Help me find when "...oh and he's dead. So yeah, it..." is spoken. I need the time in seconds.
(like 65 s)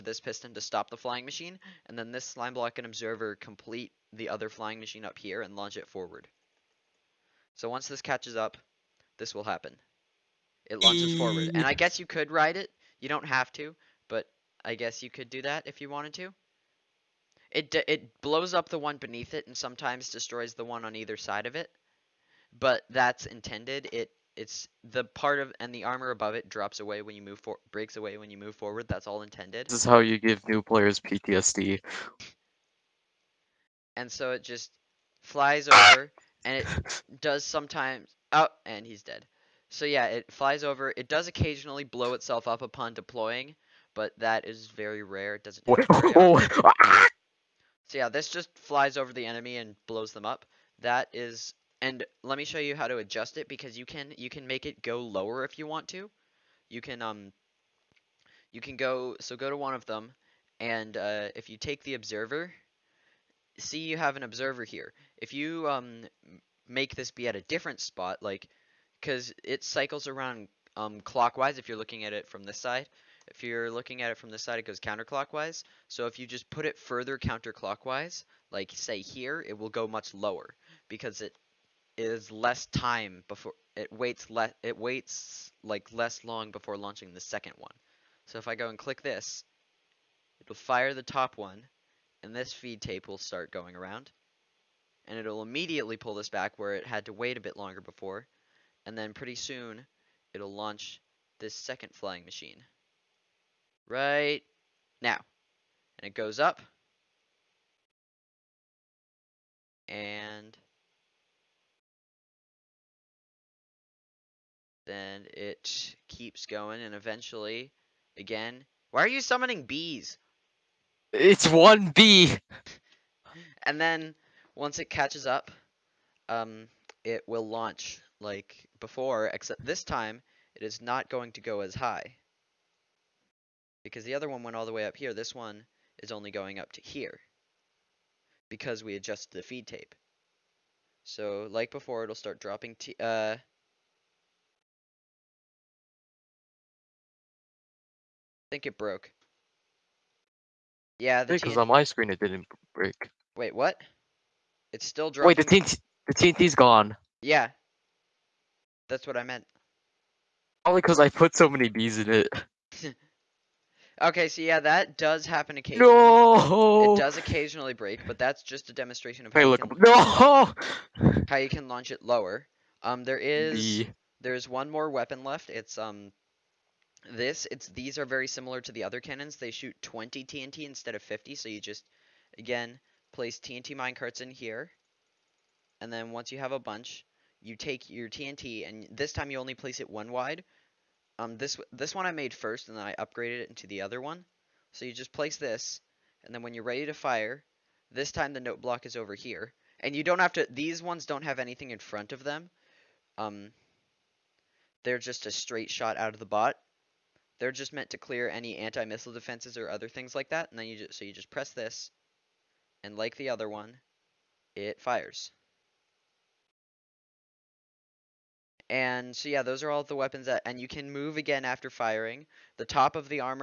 38 s.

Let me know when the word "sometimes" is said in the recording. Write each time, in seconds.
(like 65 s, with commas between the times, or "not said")
19 s, 37 s.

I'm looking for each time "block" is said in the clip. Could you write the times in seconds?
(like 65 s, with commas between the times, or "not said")
2 s, 198 s.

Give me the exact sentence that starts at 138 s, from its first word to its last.
Because we adjusted the feed tape.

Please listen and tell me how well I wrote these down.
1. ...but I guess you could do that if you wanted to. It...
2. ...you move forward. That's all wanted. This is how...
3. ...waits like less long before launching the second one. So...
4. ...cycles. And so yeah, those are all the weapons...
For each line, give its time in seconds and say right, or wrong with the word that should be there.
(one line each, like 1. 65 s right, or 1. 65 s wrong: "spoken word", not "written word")
1. 14 s right
2. 28 s wrong: "intended", not "wanted"
3. 84 s right
4. 214 s wrong: "fires", not "cycles".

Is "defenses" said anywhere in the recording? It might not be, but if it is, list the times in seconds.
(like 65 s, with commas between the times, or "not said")
209 s.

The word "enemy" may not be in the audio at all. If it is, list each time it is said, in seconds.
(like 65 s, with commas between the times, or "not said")
49 s.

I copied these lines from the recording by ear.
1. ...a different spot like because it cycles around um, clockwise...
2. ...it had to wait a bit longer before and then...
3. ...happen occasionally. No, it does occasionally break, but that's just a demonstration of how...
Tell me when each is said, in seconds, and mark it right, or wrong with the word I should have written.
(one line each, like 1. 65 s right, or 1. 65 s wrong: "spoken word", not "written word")
1. 67 s right
2. 96 s right
3. 165 s right.